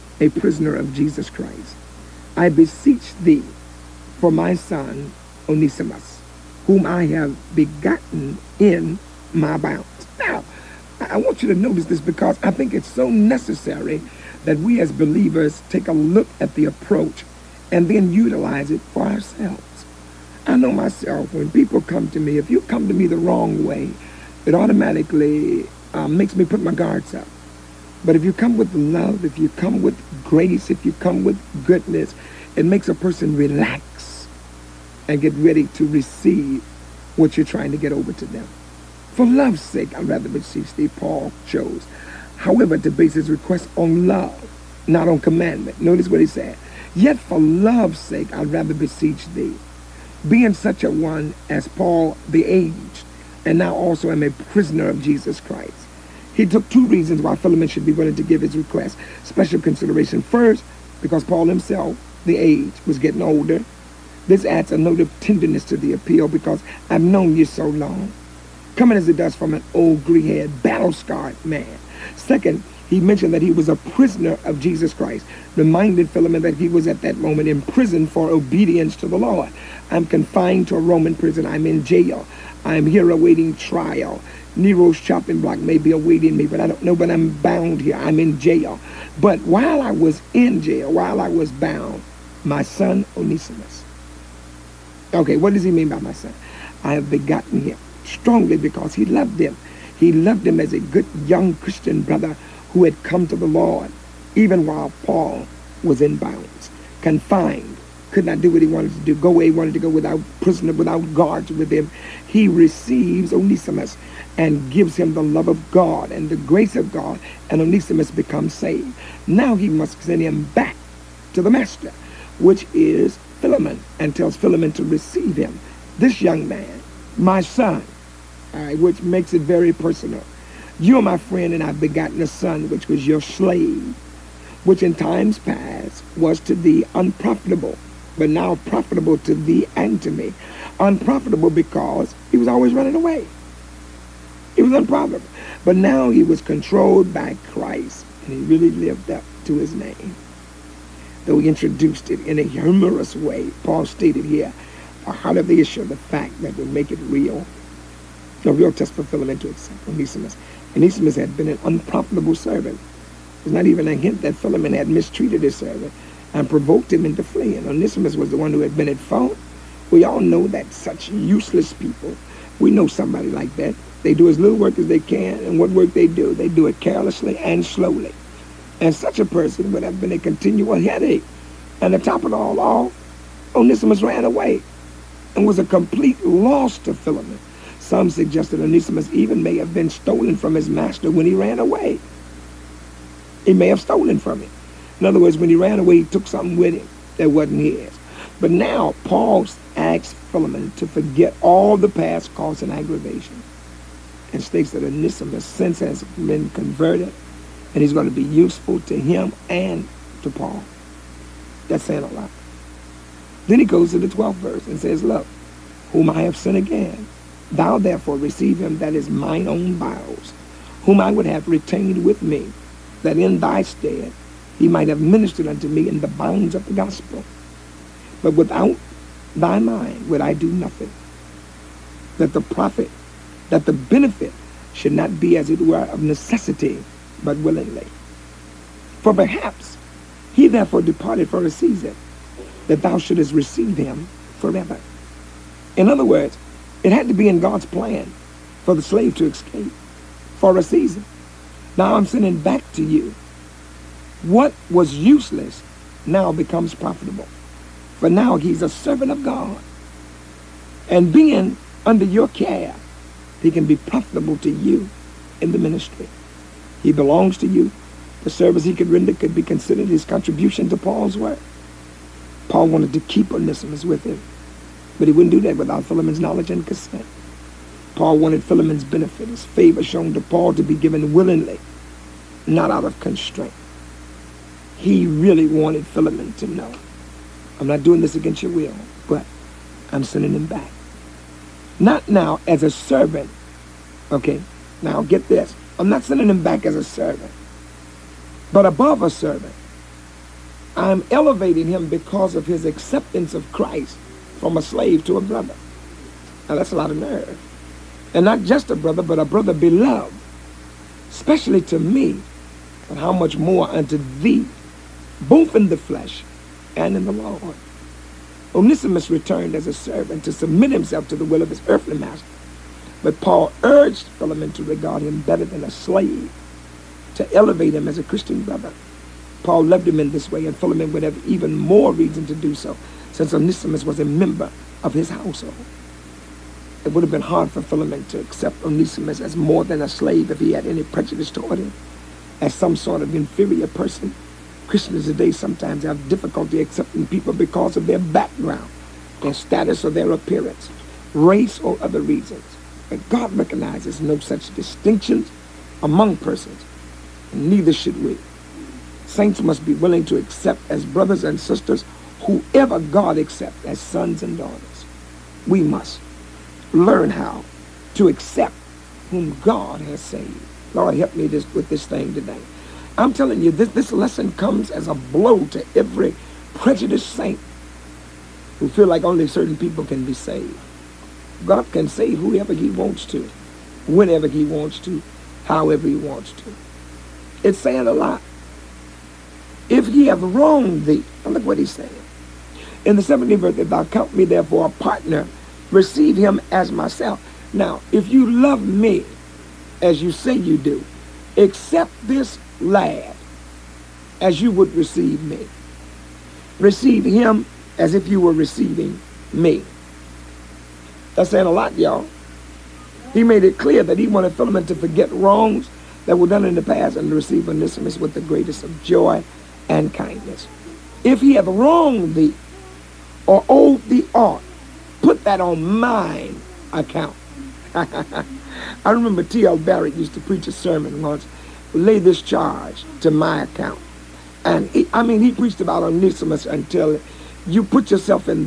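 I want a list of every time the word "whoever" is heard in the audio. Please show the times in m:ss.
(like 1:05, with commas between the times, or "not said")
6:02, 6:22.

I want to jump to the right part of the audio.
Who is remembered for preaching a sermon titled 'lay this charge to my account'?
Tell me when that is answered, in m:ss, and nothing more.
7:09.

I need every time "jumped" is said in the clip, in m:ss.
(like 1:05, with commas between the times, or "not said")
not said.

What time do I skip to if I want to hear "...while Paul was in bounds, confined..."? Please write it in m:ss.
1:44.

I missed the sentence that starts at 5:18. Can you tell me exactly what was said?
Onesimus returned as a servant to submit himself to the will of his earthly master.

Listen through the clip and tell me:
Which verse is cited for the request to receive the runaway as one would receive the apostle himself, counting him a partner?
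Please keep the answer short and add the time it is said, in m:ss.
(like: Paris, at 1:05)
17th, at 6:33.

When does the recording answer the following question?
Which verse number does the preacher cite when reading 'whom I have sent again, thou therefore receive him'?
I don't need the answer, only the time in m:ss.
3:34.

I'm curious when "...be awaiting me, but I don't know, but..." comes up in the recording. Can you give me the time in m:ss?
1:25.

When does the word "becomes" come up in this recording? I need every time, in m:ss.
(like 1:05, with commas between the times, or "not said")
1:58, 4:16.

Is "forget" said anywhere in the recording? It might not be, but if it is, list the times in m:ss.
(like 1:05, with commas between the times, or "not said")
3:20, 6:54.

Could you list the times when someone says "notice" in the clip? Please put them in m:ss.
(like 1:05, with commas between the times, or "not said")
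0:11, 0:45.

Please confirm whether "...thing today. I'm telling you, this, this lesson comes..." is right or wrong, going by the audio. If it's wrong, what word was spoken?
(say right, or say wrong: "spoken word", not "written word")
right.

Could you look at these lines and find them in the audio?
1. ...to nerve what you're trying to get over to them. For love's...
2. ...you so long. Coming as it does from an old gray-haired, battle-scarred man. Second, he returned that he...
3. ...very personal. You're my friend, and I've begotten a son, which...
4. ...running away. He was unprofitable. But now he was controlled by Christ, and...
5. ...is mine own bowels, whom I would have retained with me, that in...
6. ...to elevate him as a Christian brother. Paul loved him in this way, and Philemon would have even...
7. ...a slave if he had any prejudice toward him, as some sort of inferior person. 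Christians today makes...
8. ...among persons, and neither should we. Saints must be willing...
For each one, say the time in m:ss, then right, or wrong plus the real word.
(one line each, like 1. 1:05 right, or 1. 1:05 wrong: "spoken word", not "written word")
1. 0:35 wrong: "receive", not "nerve"
2. 1:07 wrong: "mentioned", not "returned"
3. 2:09 right
4. 2:22 right
5. 3:38 right
6. 5:27 right
7. 5:39 wrong: "sometimes", not "makes"
8. 5:55 right.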